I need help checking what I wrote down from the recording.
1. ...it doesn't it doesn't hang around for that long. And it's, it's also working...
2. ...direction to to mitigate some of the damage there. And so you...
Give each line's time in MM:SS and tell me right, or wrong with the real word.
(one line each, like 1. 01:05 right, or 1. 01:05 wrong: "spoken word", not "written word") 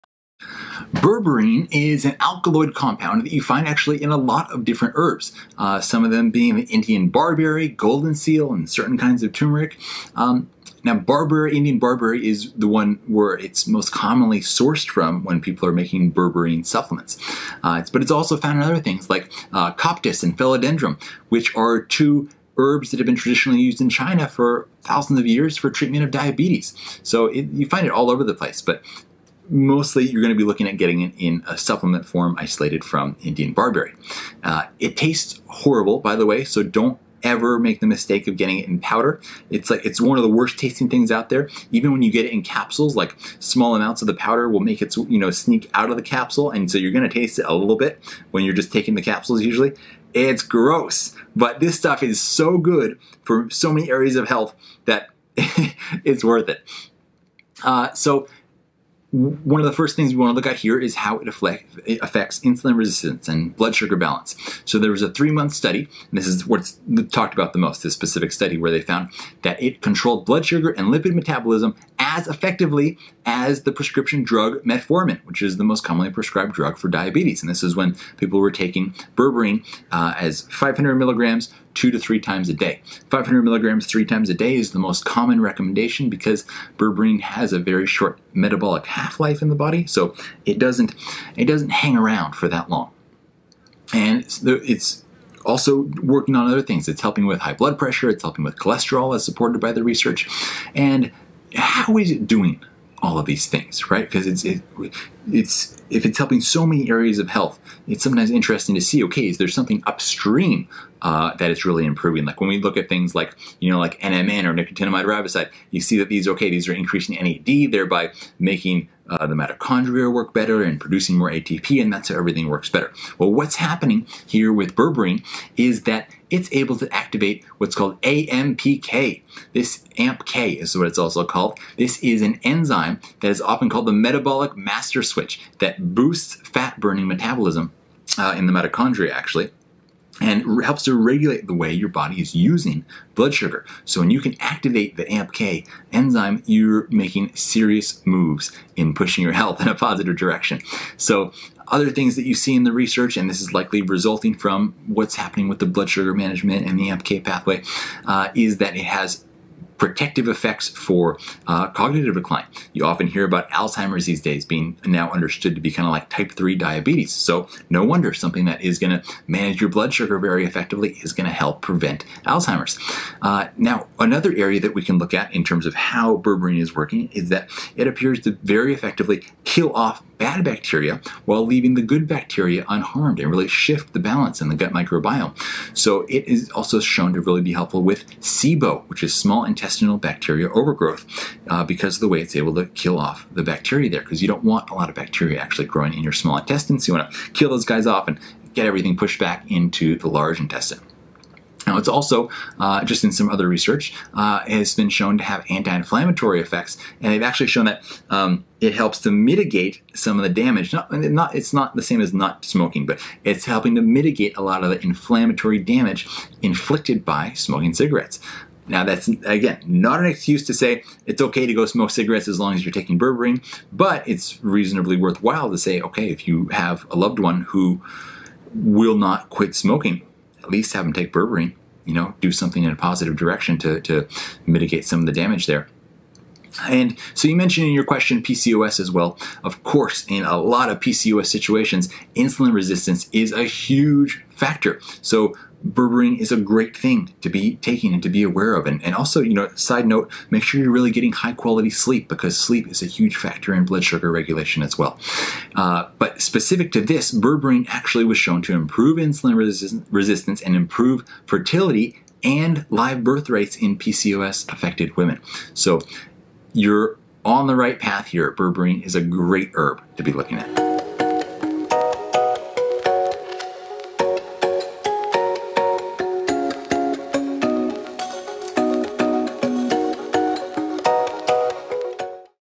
1. 01:30 right
2. 03:53 right.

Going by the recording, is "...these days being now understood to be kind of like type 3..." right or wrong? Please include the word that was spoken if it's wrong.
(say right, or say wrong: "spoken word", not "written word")
right.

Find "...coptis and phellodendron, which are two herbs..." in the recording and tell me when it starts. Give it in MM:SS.
00:19.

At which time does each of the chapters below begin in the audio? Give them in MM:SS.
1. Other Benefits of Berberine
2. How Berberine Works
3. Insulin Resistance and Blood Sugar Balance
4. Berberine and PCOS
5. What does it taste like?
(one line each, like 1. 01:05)
1. 02:31
2. 01:41
3. 00:58
4. 03:56
5. 00:34.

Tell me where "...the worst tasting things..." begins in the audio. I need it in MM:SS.
00:40.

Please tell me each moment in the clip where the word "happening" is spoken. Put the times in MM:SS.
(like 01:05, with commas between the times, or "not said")
02:03, 02:35.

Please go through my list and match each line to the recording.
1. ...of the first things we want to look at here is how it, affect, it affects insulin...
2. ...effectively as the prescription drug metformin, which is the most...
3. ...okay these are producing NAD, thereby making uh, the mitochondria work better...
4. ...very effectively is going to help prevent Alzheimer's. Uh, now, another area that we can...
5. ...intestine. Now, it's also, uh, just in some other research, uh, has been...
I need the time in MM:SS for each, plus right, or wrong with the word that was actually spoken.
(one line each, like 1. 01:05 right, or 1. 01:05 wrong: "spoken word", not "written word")
1. 00:59 right
2. 01:12 right
3. 01:56 wrong: "increasing", not "producing"
4. 02:50 right
5. 03:20 right.